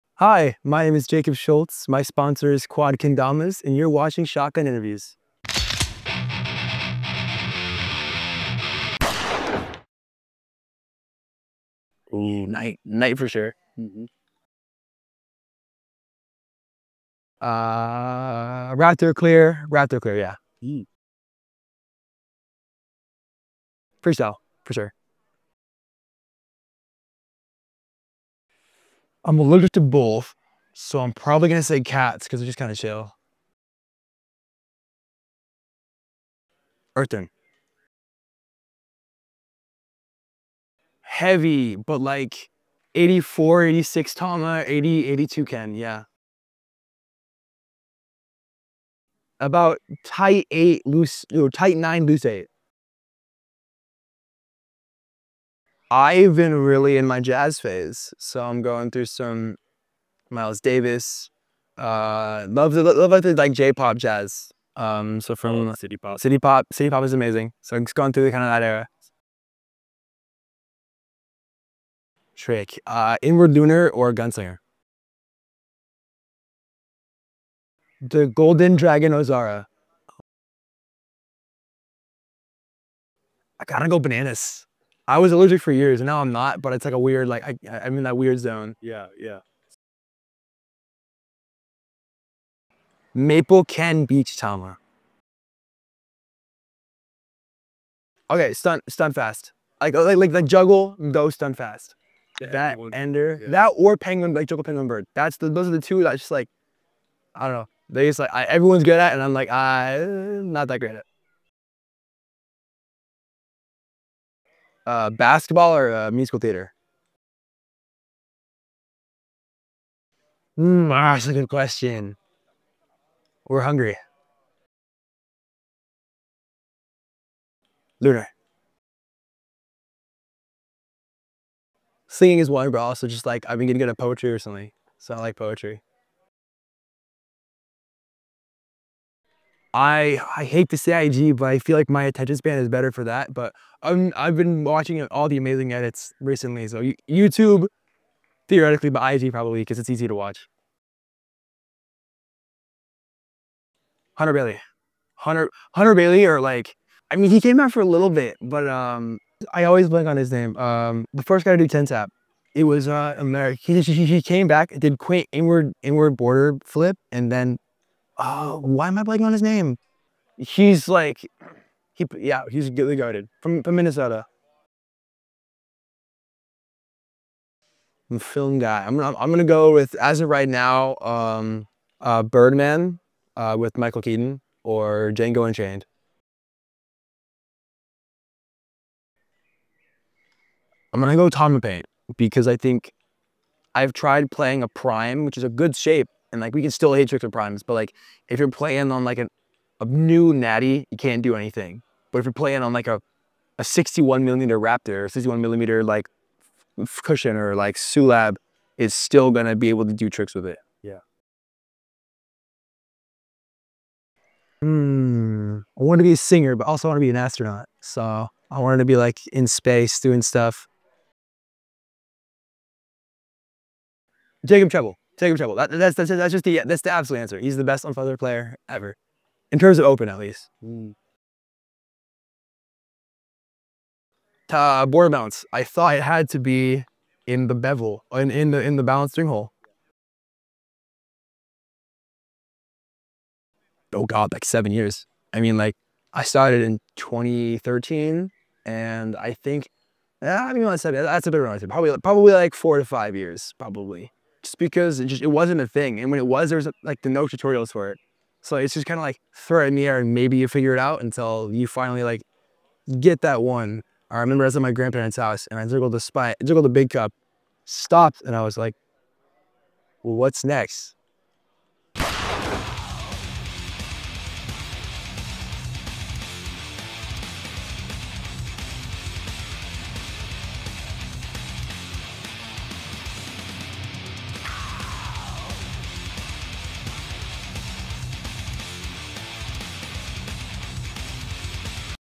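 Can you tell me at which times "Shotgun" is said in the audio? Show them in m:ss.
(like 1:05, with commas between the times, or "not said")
0:04.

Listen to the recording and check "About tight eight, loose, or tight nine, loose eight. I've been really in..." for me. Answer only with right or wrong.
right.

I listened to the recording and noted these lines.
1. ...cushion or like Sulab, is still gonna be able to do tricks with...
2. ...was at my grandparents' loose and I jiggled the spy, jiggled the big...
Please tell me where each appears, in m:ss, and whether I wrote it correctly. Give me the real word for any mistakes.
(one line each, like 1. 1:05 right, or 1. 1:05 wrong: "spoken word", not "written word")
1. 3:27 right
2. 4:24 wrong: "house", not "loose".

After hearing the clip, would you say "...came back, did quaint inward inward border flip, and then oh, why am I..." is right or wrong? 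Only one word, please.
right.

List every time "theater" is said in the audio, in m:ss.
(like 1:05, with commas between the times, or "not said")
1:56.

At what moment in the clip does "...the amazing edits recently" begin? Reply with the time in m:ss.
2:25.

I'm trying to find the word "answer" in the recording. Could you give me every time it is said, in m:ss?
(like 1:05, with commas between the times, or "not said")
3:47.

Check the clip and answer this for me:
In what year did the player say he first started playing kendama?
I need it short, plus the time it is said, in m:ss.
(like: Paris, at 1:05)
2013, at 4:06.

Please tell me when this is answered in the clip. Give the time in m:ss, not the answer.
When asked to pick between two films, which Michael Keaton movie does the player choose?
3:02.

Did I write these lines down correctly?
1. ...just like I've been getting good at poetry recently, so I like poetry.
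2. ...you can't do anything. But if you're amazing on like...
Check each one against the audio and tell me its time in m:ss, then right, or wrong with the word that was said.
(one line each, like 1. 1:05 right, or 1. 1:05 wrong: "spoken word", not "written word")
1. 2:13 right
2. 3:20 wrong: "playing", not "amazing".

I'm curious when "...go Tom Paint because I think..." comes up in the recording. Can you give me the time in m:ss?
3:11.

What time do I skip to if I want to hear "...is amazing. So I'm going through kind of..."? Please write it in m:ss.
1:07.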